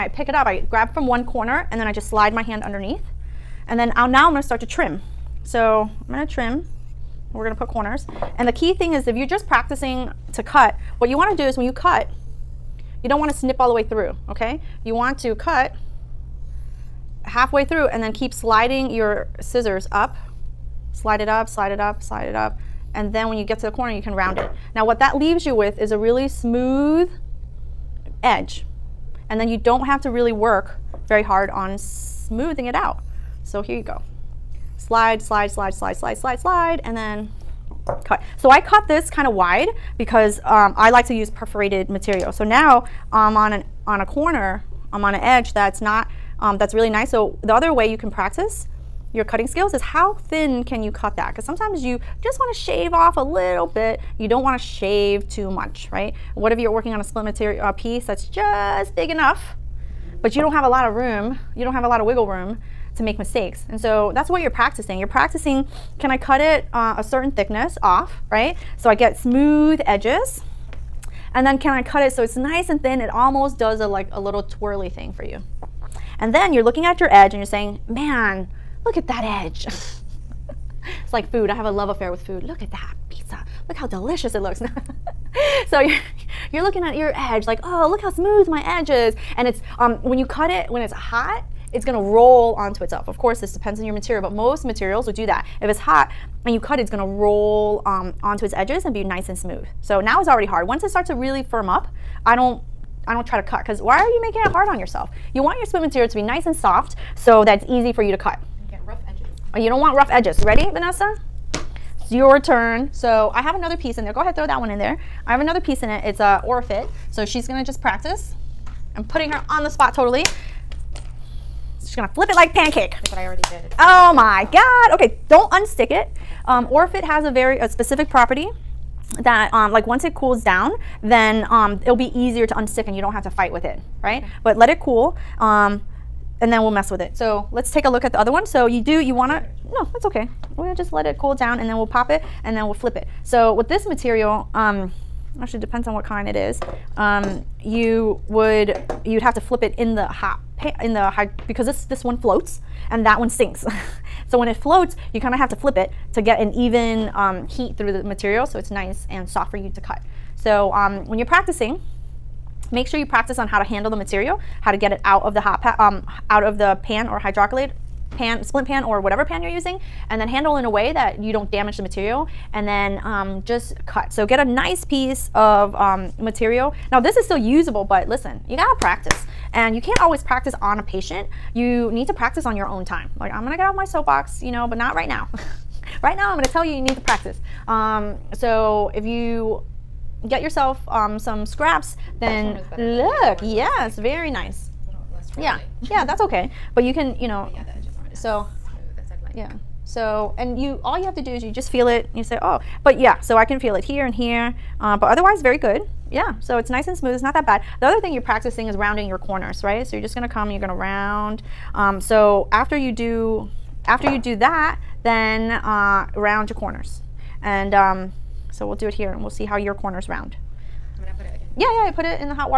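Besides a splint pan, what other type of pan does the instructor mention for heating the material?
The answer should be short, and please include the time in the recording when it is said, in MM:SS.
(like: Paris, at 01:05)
hydrocollator pan, at 02:47.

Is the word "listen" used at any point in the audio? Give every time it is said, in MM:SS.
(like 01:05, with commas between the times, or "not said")
02:58.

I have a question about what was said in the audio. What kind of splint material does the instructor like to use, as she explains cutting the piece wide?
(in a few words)
perforated material.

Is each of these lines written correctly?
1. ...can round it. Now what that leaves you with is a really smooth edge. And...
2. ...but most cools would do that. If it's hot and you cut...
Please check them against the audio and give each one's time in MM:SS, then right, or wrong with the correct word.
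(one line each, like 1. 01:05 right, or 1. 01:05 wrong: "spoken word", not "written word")
1. 00:24 right
2. 01:34 wrong: "materials", not "cools".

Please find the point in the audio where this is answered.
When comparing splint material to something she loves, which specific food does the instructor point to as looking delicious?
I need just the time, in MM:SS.
01:23.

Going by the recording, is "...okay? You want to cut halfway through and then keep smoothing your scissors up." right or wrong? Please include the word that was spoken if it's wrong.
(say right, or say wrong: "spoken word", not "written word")
wrong: "sliding", not "smoothing".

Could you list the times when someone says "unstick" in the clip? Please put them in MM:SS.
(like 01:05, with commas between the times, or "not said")
02:05, 02:12.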